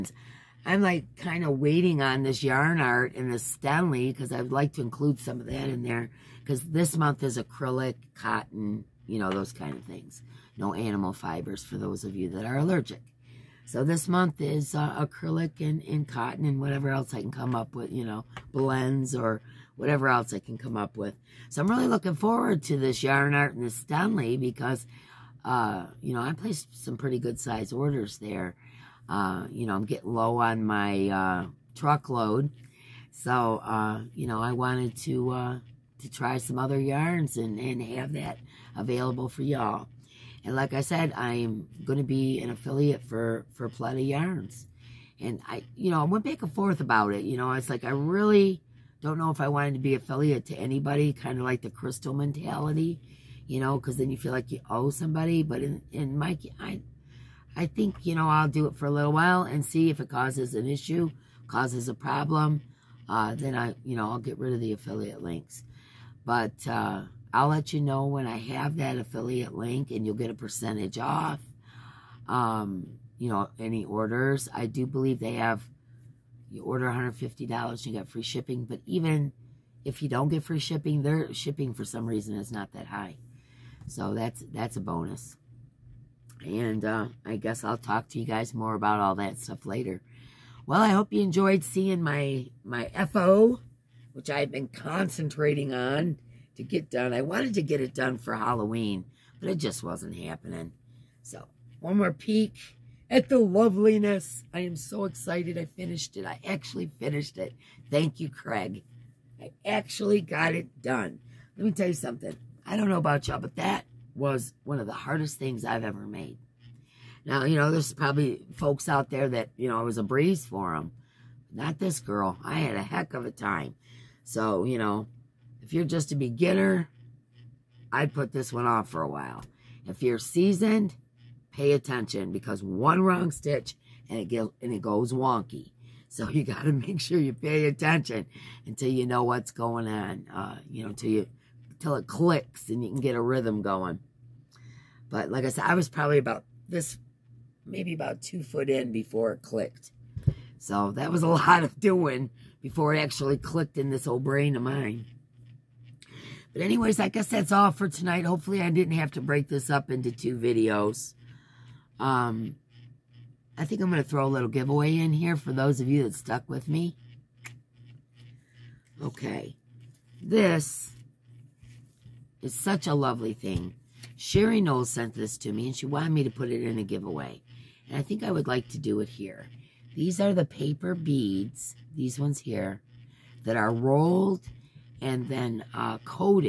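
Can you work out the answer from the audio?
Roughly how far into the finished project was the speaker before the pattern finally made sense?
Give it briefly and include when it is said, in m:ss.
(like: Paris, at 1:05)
2 foot, at 2:28.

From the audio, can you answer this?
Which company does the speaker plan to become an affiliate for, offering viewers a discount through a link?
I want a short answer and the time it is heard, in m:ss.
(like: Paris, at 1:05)
Plenty Yarns, at 0:43.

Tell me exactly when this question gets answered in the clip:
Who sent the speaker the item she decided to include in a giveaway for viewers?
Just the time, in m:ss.
2:54.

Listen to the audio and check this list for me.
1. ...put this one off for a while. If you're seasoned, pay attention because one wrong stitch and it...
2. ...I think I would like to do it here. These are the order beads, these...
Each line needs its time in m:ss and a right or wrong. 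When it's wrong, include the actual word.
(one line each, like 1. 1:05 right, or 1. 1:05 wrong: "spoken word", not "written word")
1. 2:08 right
2. 2:57 wrong: "paper", not "order".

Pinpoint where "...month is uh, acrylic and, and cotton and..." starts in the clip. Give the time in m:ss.
0:14.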